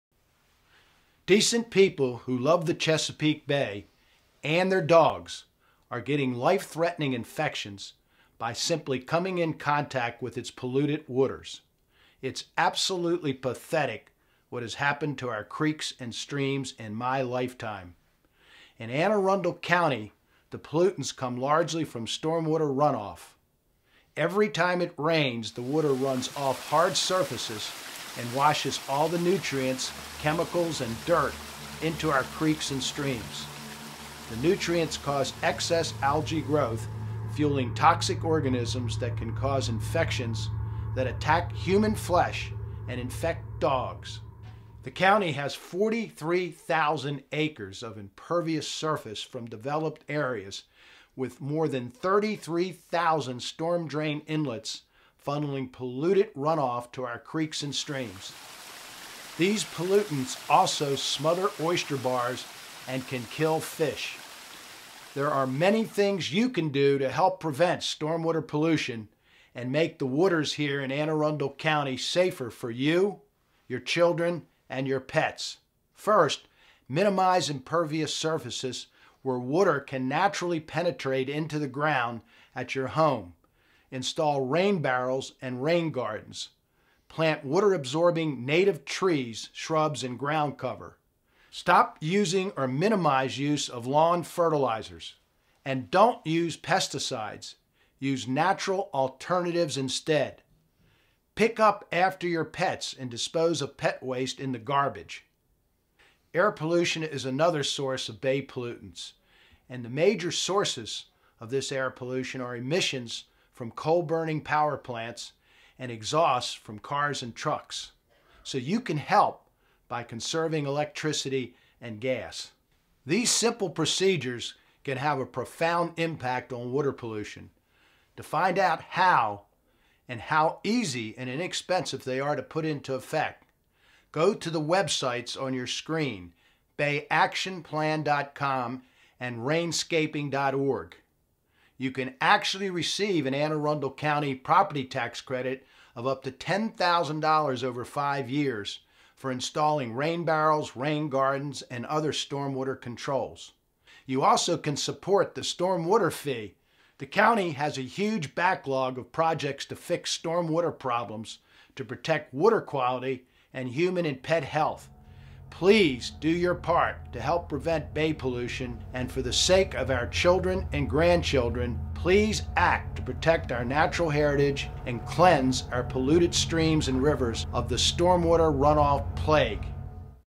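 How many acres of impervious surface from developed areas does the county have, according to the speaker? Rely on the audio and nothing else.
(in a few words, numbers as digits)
43,000.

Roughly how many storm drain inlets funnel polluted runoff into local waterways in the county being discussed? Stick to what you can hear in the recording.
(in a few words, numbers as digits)
33,000.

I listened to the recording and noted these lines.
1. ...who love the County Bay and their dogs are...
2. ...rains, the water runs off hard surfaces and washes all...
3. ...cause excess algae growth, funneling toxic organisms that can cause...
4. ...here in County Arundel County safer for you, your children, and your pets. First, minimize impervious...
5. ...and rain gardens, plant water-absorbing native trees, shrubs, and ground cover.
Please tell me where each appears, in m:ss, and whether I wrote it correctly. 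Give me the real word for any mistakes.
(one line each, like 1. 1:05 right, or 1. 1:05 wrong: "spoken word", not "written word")
1. 0:02 wrong: "Chesapeake", not "County"
2. 0:24 right
3. 0:34 wrong: "fueling", not "funneling"
4. 1:10 wrong: "Anne", not "County"
5. 1:25 right.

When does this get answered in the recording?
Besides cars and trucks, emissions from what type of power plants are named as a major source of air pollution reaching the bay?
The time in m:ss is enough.
1:53.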